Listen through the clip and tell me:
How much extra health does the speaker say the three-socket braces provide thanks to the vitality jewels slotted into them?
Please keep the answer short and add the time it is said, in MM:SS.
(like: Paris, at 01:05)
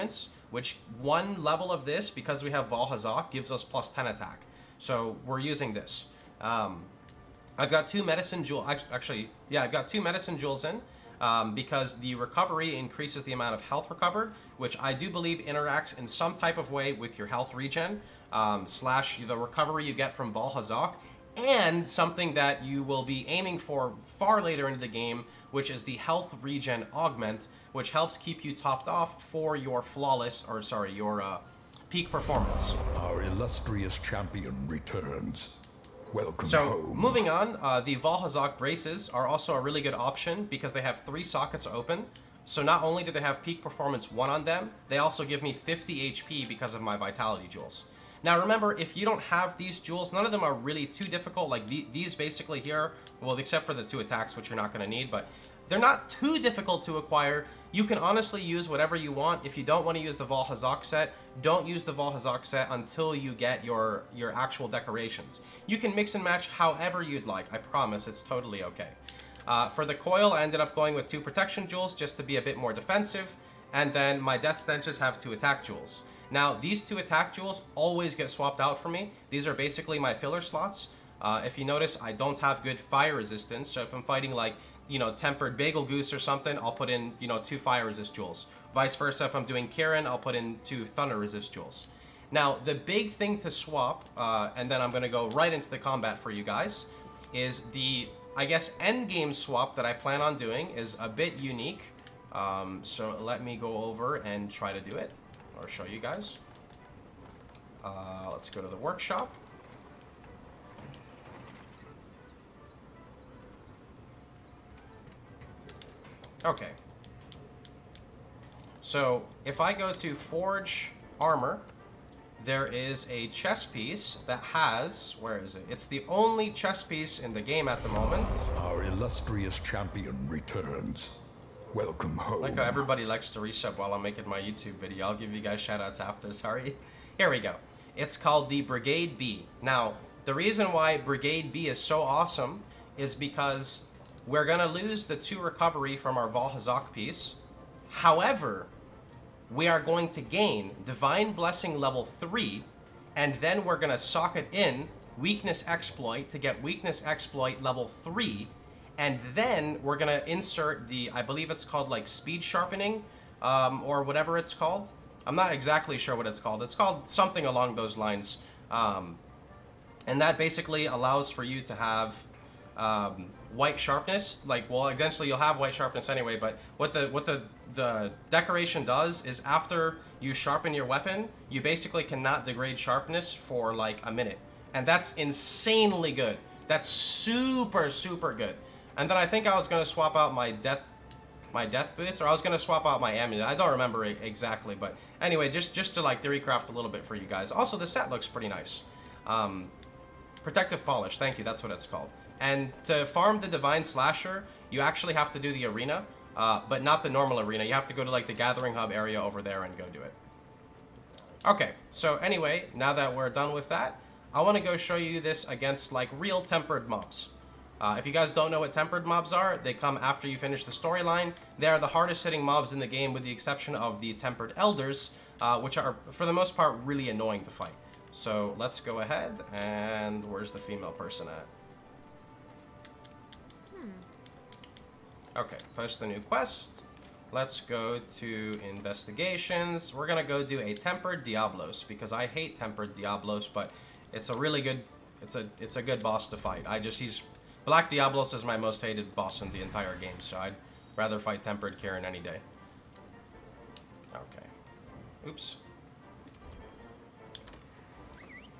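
50 HP, at 00:45.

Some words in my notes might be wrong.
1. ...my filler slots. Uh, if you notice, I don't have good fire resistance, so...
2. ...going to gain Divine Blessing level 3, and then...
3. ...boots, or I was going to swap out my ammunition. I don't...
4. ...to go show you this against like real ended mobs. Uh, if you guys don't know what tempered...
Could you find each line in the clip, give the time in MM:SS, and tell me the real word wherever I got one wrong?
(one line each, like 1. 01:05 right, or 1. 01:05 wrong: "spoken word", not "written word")
1. 01:19 right
2. 02:29 right
3. 03:11 right
4. 03:34 wrong: "tempered", not "ended".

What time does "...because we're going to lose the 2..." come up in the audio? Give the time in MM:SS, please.
02:23.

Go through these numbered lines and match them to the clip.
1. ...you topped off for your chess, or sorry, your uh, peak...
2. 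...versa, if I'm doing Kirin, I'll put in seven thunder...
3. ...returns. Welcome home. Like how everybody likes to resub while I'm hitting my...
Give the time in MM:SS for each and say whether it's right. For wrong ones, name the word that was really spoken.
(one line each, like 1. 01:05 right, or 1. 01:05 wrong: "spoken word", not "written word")
1. 00:28 wrong: "flawless", not "chess"
2. 01:28 wrong: "two", not "seven"
3. 02:10 wrong: "making", not "hitting".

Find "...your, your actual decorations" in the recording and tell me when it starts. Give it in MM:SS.
01:03.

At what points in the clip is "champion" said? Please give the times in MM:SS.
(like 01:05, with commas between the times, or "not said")
00:33, 02:09.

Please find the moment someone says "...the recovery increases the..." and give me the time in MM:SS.
00:11.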